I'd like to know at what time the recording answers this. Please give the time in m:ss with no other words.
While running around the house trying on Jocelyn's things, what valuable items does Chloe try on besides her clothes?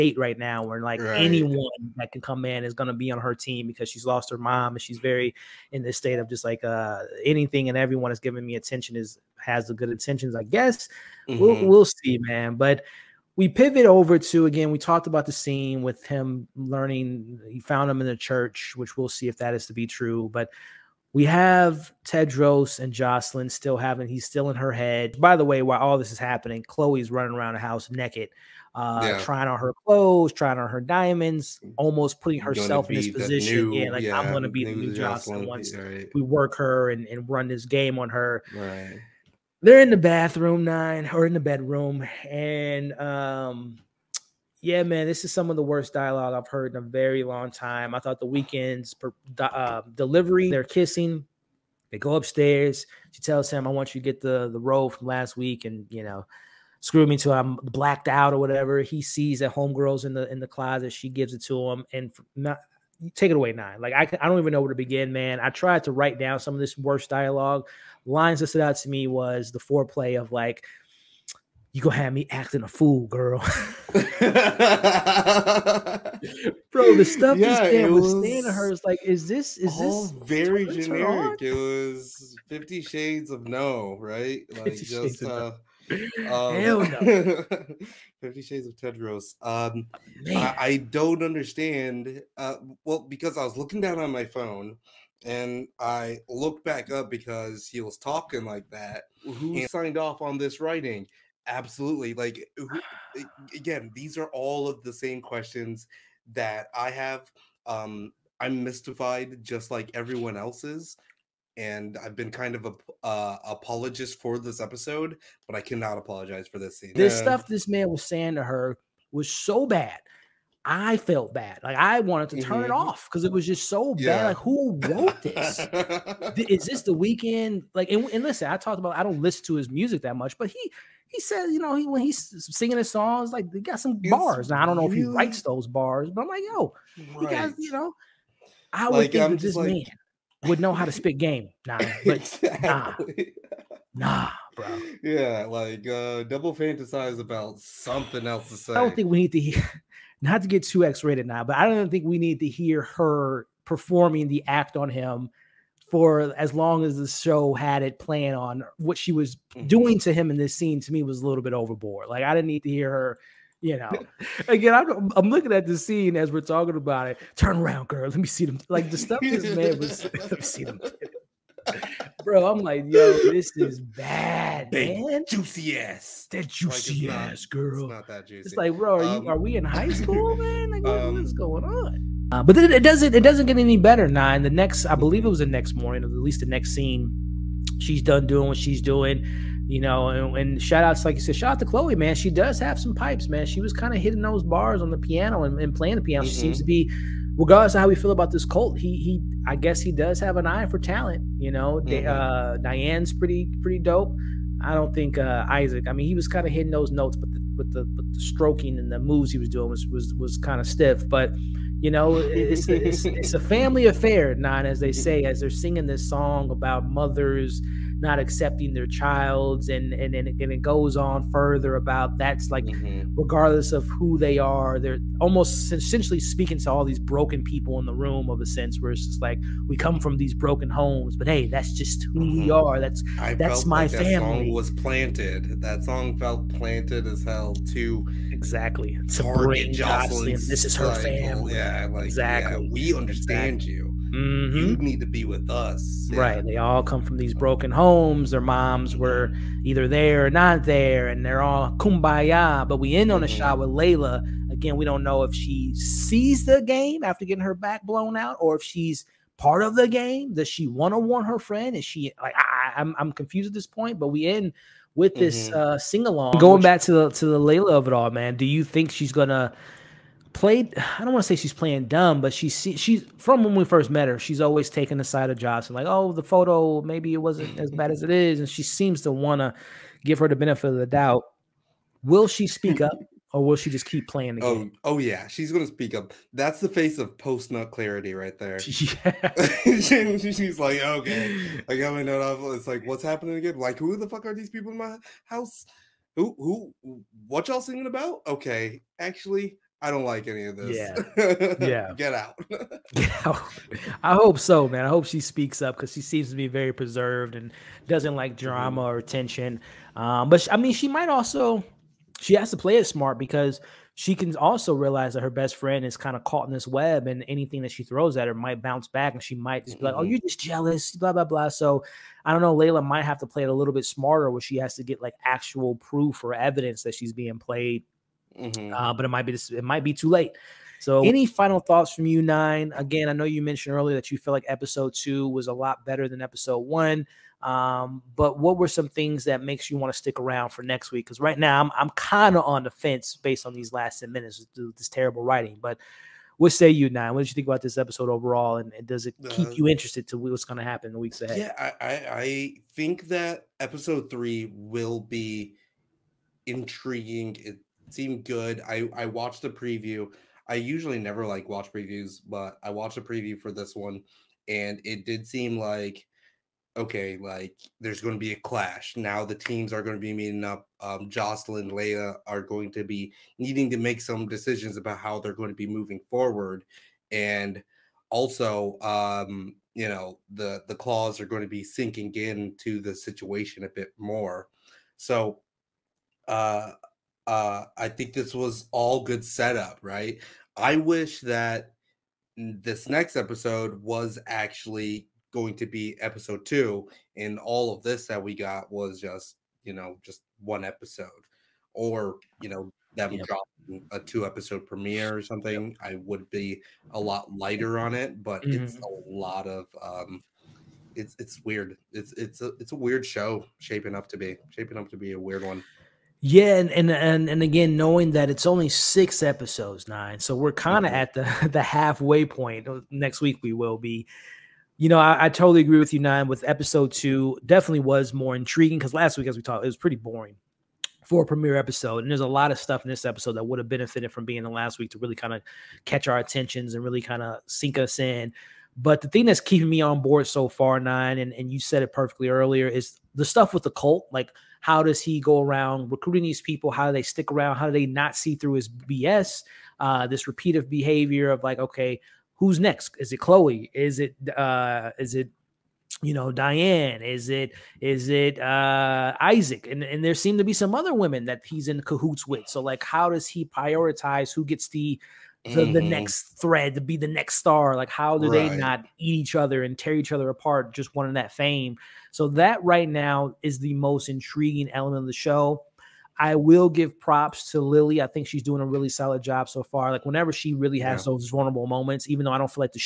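0:30.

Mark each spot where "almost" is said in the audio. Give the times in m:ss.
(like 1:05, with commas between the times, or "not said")
0:31, 3:45.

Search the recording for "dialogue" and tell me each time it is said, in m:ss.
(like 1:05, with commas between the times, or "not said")
0:45, 1:07.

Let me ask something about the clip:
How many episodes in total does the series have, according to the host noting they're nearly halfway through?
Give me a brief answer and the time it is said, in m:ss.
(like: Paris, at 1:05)
6, at 6:58.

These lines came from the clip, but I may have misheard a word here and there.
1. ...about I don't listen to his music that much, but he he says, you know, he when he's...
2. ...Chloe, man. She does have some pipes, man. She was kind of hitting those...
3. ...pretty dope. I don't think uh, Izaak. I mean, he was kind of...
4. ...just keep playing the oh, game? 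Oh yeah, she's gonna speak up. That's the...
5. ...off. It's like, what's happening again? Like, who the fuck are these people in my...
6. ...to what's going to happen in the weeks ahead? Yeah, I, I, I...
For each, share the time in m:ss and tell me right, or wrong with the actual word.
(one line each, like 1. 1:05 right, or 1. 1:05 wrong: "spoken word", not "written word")
1. 2:08 right
2. 3:11 right
3. 3:23 right
4. 4:43 right
5. 4:52 right
6. 5:50 right.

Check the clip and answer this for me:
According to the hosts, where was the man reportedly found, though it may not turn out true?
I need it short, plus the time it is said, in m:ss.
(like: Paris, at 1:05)
The church, at 0:18.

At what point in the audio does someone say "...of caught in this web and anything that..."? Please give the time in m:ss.
5:16.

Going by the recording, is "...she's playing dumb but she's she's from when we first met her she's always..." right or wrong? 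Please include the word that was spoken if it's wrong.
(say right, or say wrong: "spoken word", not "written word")
right.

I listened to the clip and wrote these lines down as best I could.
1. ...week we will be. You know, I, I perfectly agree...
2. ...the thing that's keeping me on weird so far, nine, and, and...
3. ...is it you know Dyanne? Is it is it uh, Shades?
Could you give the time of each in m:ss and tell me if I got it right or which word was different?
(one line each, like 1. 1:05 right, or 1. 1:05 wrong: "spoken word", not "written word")
1. 7:03 wrong: "totally", not "perfectly"
2. 7:19 wrong: "board", not "weird"
3. 7:34 wrong: "Izaak", not "Shades".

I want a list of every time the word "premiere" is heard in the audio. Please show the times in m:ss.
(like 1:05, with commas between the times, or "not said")
6:44, 7:11.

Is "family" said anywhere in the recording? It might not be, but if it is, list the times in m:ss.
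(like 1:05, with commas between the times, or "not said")
3:33, 4:00.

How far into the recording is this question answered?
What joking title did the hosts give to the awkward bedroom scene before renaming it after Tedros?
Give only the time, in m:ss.
1:22.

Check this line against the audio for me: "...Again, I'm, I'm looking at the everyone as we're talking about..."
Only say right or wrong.
wrong.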